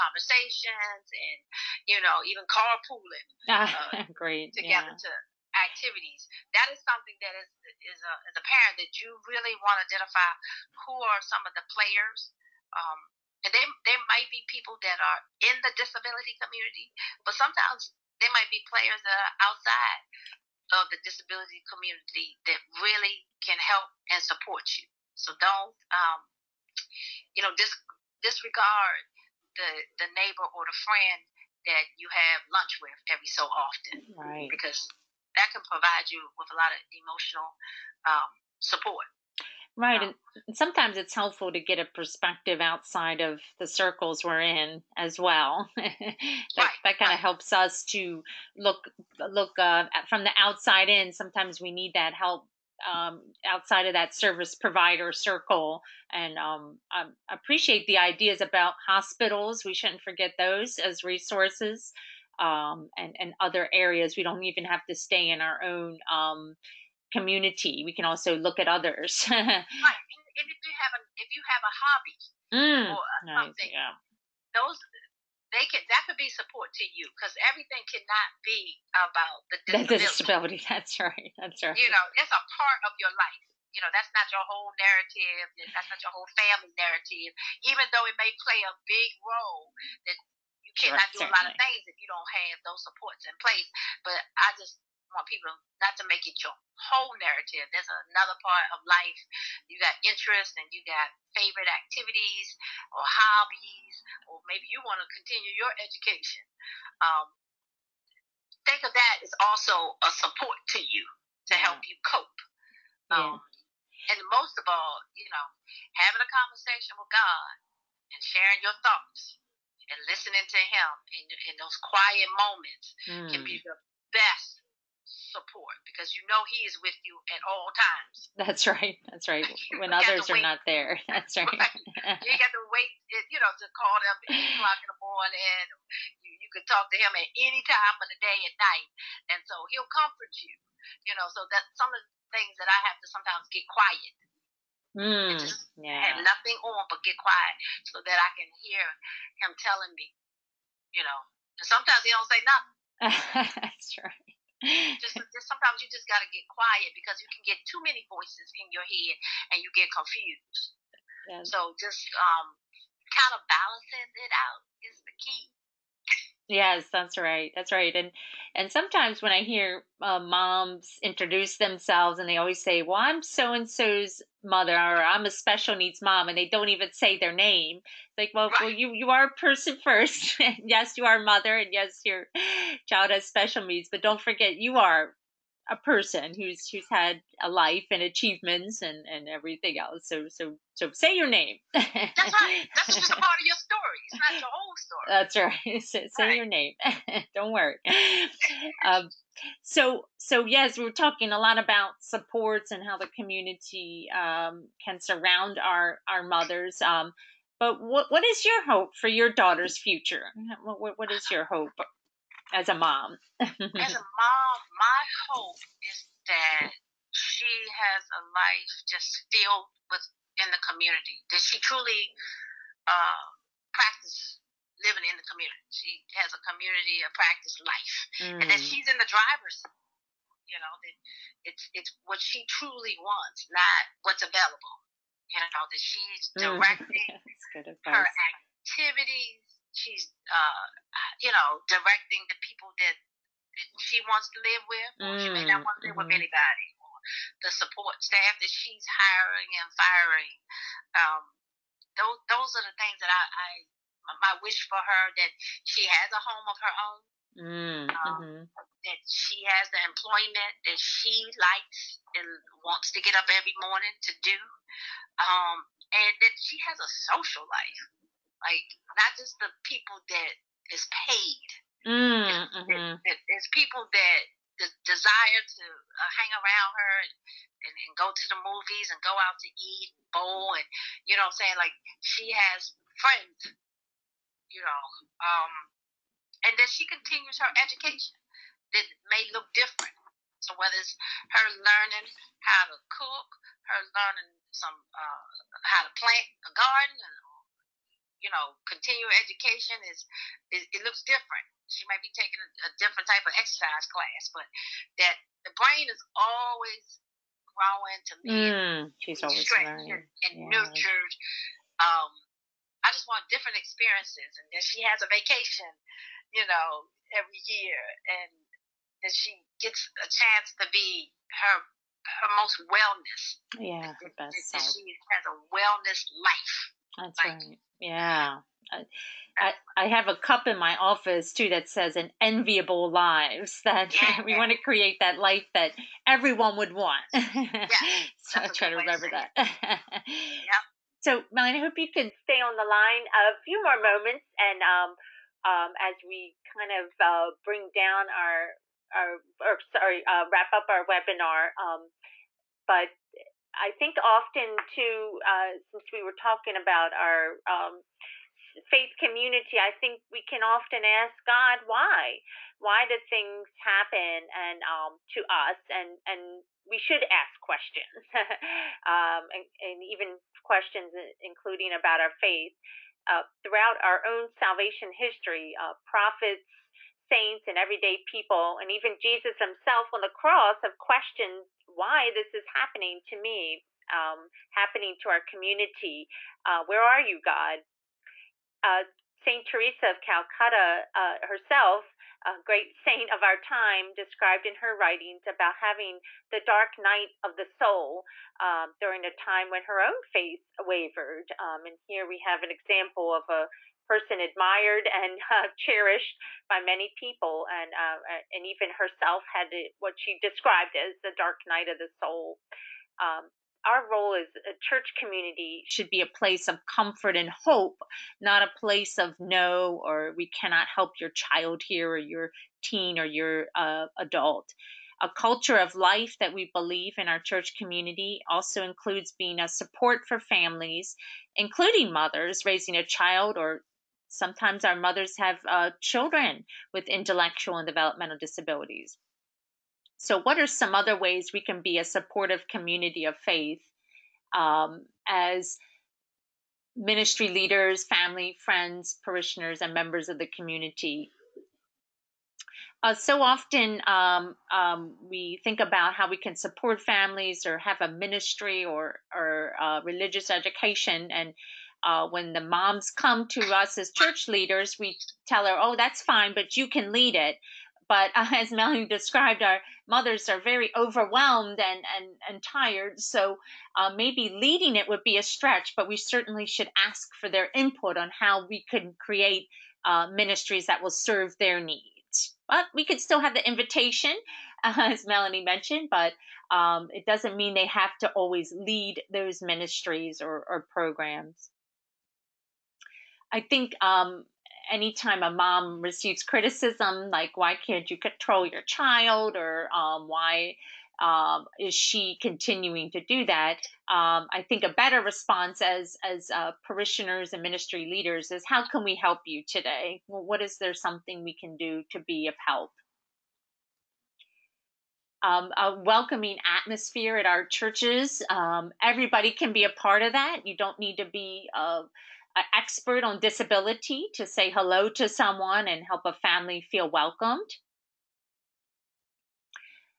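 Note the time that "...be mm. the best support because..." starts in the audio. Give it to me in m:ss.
2:03.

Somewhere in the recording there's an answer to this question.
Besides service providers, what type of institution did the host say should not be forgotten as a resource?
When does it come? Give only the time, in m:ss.
0:58.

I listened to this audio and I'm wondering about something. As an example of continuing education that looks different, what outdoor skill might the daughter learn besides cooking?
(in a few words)
plant a garden.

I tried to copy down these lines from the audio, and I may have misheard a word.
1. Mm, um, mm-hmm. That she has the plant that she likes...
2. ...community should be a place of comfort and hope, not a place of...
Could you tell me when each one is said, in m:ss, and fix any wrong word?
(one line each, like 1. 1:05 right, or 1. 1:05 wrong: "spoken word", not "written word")
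1. 4:17 wrong: "employment", not "plant"
2. 6:54 right.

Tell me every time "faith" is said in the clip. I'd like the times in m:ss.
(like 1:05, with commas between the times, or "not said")
5:58, 6:12, 6:40, 7:23.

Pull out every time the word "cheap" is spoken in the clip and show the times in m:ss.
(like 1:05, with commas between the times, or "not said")
not said.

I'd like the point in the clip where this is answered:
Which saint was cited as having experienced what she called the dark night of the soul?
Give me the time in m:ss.
6:29.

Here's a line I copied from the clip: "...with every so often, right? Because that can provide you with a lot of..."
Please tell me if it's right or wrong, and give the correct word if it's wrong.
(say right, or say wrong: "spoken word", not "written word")
right.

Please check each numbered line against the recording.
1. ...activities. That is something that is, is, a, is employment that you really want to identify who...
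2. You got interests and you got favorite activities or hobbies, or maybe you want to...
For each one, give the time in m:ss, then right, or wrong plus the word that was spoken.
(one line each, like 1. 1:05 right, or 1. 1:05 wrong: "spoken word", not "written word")
1. 0:05 wrong: "apparent", not "employment"
2. 1:39 right.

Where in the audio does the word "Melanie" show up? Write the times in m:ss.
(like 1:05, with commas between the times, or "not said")
5:41, 7:48, 8:05.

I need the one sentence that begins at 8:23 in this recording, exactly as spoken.
Um, I think a better response as as uh, parishioners and ministry leaders is how can we help you today?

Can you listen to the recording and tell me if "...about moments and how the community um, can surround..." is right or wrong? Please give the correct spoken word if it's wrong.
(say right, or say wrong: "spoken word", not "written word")
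wrong: "supports", not "moments".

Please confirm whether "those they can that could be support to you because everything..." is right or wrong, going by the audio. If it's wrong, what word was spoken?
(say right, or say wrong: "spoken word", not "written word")
right.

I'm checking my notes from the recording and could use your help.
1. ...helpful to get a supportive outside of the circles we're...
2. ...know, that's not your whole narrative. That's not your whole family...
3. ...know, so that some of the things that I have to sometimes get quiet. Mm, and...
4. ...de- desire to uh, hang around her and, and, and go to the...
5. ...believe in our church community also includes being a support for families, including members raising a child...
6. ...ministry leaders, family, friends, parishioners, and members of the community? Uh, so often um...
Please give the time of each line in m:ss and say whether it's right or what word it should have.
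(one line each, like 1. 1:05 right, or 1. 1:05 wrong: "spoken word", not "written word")
1. 0:41 wrong: "perspective", not "supportive"
2. 1:23 right
3. 2:21 right
4. 4:34 right
5. 7:06 wrong: "mothers", not "members"
6. 7:26 right.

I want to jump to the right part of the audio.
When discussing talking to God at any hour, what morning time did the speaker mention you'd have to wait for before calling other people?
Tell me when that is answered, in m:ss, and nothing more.
2:14.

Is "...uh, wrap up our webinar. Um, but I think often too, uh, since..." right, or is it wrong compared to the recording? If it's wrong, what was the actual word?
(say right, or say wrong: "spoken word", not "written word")
right.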